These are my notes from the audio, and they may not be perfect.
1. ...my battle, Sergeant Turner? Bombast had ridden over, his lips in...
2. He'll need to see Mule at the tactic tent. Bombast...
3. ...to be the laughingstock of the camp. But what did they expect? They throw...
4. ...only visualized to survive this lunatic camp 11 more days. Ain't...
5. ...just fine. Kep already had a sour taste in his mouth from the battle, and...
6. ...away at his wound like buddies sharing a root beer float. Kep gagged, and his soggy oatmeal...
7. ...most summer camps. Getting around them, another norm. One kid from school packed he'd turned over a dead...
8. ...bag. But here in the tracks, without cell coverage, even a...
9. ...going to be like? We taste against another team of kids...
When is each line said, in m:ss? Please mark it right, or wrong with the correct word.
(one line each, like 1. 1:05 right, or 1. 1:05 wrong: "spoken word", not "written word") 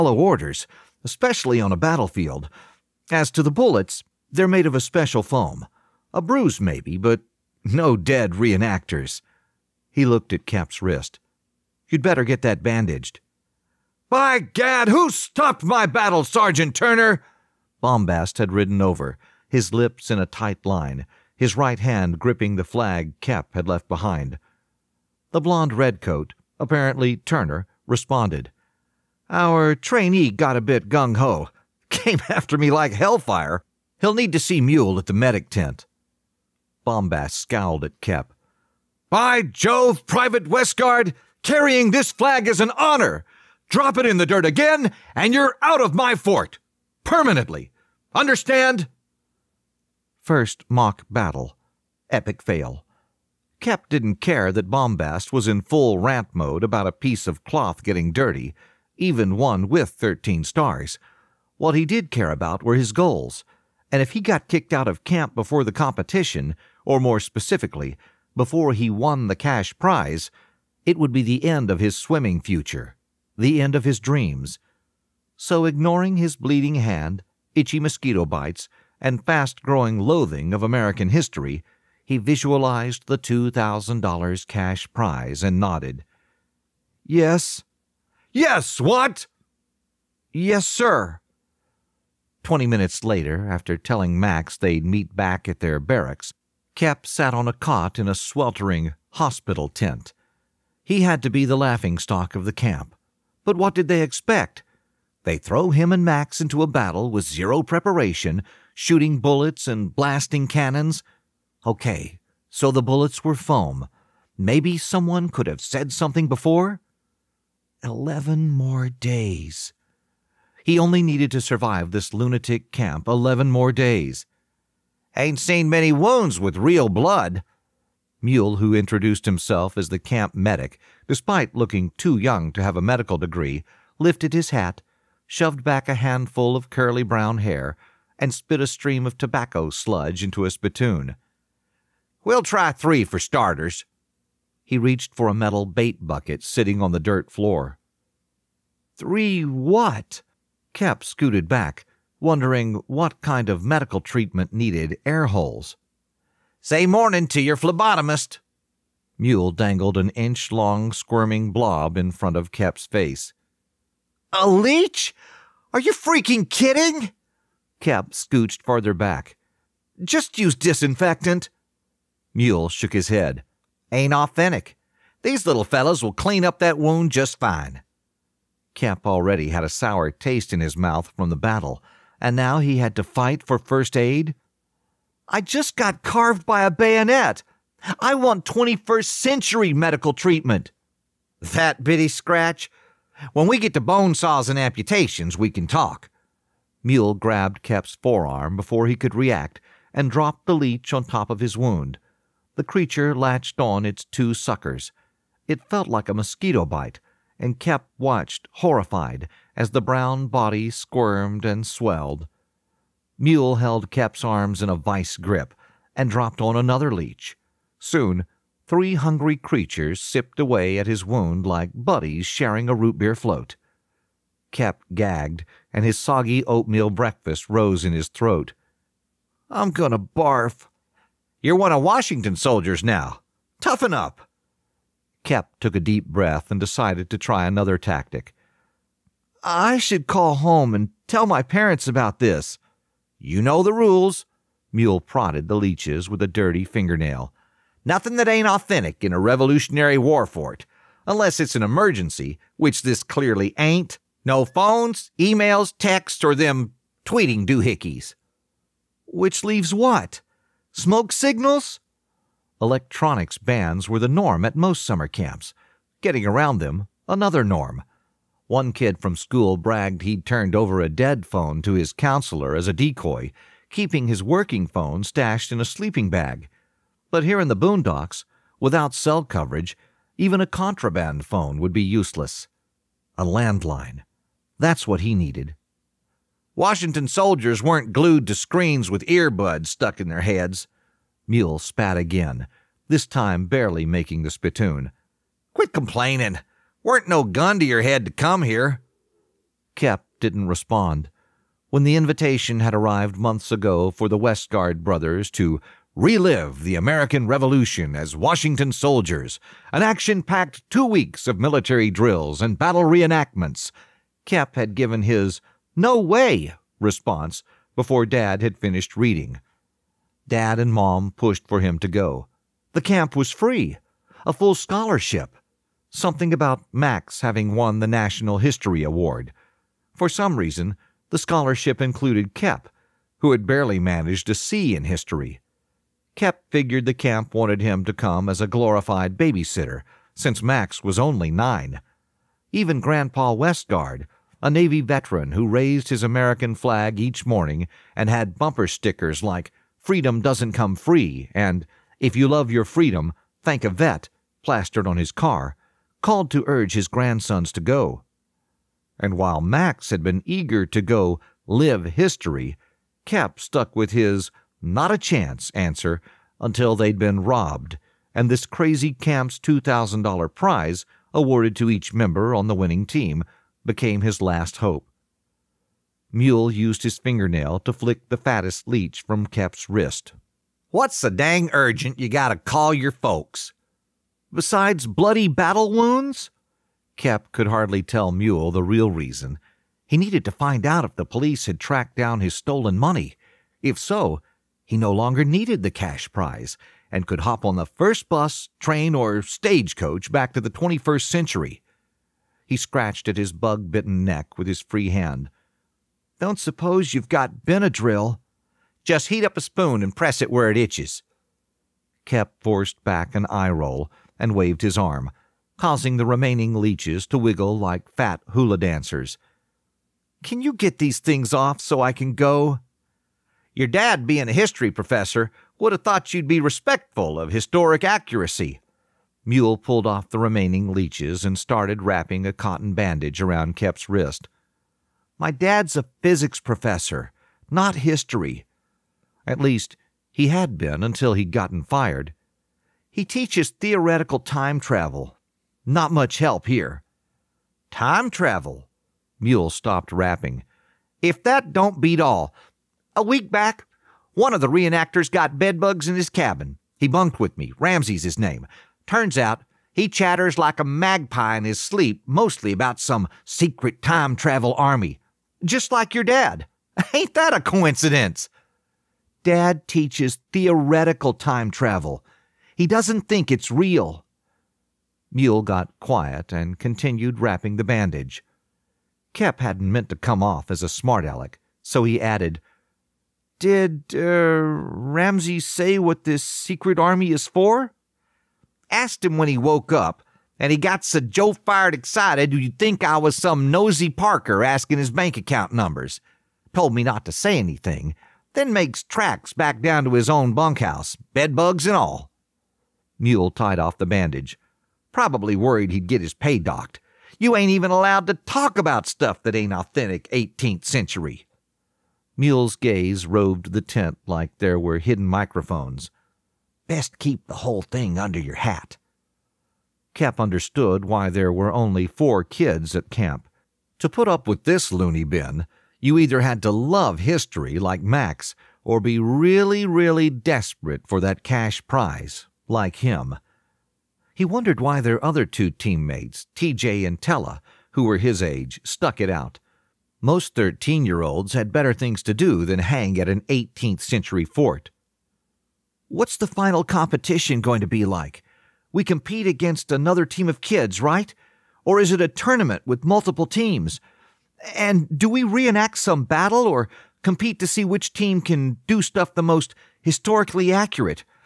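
1. 0:15 right
2. 0:33 wrong: "medic", not "tactic"
3. 1:41 right
4. 2:00 wrong: "needed", not "visualized"
5. 2:57 right
6. 3:40 right
7. 4:24 wrong: "bragged", not "packed"
8. 4:36 wrong: "boondocks", not "tracks"
9. 9:07 wrong: "compete", not "taste".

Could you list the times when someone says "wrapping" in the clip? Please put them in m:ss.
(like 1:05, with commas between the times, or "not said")
7:11, 7:29, 7:57.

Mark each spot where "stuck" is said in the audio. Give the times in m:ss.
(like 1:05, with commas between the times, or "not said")
4:49, 6:03, 8:58.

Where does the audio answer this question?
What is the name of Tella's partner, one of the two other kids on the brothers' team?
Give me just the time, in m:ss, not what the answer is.
8:56.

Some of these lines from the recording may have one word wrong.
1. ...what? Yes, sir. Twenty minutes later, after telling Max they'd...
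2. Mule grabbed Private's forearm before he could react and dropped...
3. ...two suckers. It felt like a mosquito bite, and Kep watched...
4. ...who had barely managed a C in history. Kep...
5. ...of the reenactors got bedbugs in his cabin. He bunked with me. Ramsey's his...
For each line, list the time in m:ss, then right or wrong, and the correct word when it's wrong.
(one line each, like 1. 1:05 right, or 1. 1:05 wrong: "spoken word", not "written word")
1. 1:28 right
2. 3:16 wrong: "Kep", not "Private"
3. 3:24 right
4. 5:33 right
5. 7:34 right.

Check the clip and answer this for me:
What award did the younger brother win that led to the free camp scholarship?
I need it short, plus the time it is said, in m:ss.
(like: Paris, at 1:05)
National History Award, at 5:27.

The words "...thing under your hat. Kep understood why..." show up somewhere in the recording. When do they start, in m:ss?
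8:37.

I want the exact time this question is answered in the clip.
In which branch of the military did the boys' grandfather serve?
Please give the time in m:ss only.
5:44.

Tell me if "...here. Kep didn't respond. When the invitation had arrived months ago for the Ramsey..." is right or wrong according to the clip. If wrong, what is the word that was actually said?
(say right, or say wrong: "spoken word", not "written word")
wrong: "Westguard", not "Ramsey".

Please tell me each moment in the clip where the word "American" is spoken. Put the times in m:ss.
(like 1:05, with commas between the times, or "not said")
1:20, 5:06, 5:46.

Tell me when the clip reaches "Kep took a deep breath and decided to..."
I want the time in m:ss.
3:55.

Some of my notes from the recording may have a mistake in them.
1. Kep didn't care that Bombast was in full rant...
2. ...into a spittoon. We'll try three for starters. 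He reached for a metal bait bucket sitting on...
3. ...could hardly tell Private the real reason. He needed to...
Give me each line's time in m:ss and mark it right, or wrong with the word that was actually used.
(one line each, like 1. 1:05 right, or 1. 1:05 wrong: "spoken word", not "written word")
1. 0:53 right
2. 2:20 right
3. 6:27 wrong: "Mule", not "Private".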